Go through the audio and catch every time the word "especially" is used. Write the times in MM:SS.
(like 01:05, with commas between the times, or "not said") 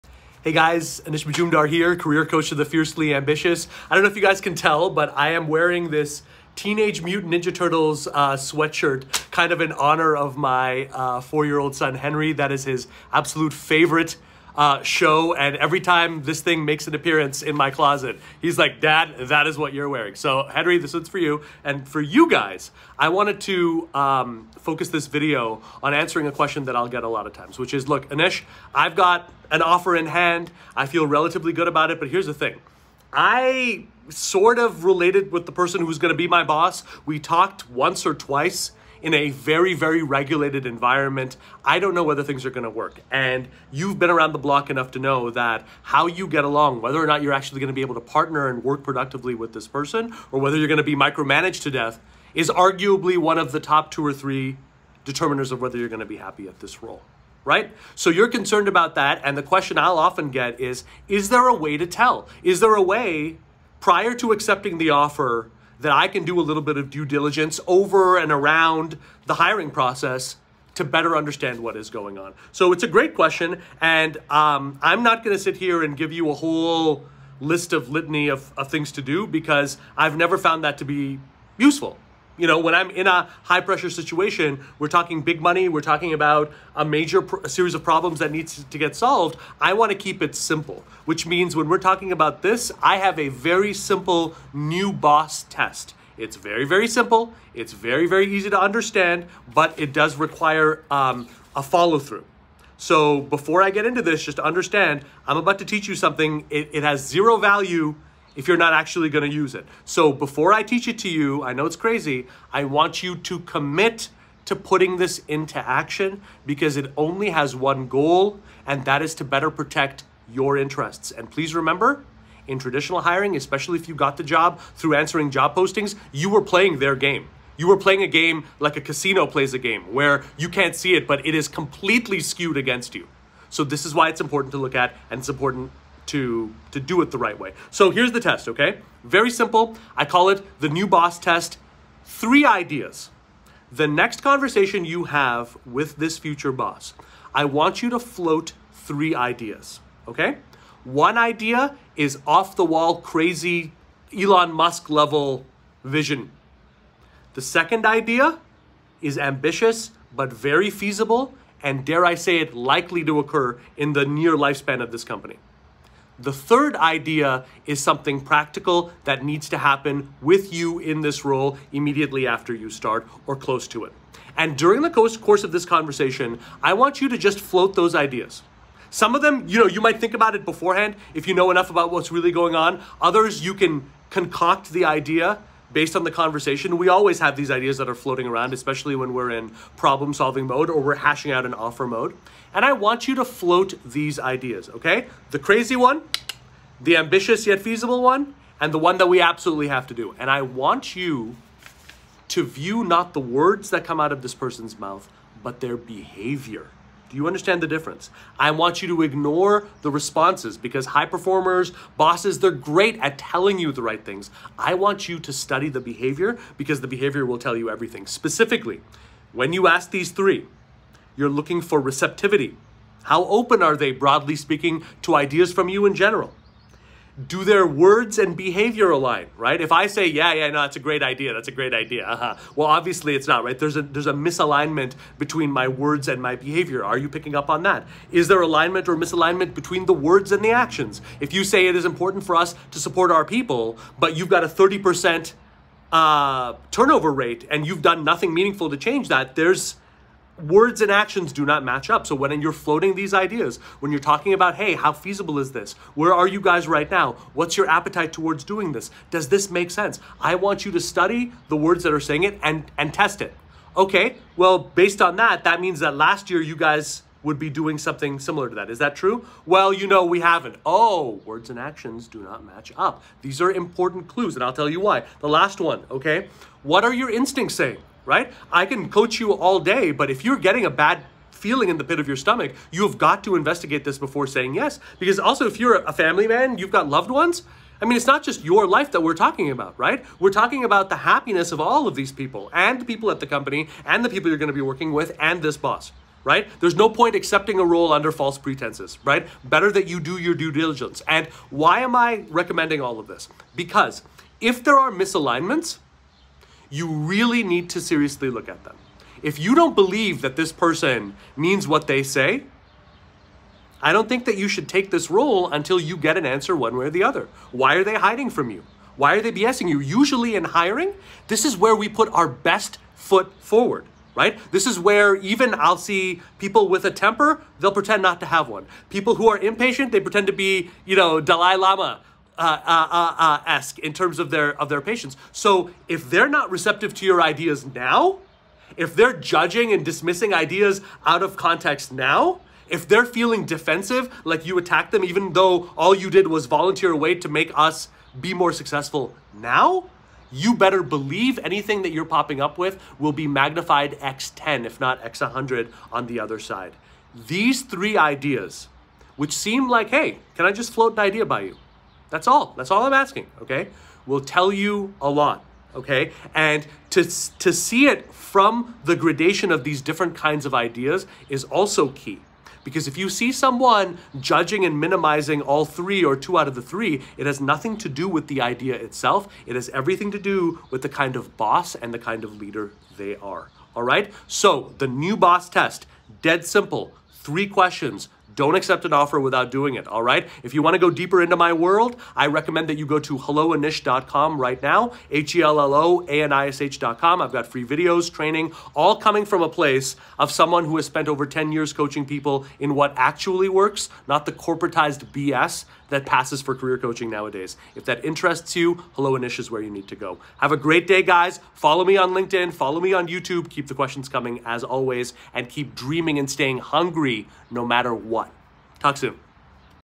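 02:03, 03:08.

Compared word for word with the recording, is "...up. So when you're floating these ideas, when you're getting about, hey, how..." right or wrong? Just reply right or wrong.
wrong.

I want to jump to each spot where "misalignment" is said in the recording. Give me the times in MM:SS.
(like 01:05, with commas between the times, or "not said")
03:54, 03:58, 05:04.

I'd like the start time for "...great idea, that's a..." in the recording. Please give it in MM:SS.
03:50.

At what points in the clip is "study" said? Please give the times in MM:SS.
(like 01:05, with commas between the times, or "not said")
03:35, 04:20.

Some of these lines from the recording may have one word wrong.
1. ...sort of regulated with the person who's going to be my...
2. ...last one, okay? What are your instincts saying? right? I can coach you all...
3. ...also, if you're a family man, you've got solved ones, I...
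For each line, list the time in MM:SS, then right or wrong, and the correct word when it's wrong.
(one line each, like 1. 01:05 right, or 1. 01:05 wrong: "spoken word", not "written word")
1. 00:34 wrong: "related", not "regulated"
2. 04:35 right
3. 04:45 wrong: "loved", not "solved".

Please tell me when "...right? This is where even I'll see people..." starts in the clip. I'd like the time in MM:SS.
05:24.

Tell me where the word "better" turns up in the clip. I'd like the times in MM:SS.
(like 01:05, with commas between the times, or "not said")
01:10, 01:59, 04:59, 05:50.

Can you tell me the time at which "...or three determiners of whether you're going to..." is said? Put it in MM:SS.
00:54.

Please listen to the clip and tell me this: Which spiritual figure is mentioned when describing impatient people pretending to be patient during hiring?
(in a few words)
Dalai Lama.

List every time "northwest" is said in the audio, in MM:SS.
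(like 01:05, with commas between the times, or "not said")
not said.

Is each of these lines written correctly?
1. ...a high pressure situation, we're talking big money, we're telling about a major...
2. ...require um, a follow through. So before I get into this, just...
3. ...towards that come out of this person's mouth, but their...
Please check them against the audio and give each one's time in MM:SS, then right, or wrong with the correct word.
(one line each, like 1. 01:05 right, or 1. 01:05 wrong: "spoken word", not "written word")
1. 01:23 wrong: "talking", not "telling"
2. 01:40 right
3. 03:23 wrong: "words", not "towards".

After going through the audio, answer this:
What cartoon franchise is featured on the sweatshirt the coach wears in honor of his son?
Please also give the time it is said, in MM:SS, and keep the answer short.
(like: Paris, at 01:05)
Teenage Mutant Ninja Turtles, at 00:06.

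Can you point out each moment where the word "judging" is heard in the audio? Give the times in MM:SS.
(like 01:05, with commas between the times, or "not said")
05:39, 06:14.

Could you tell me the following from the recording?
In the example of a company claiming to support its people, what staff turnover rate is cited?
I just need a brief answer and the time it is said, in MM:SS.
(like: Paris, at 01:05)
30%, at 04:04.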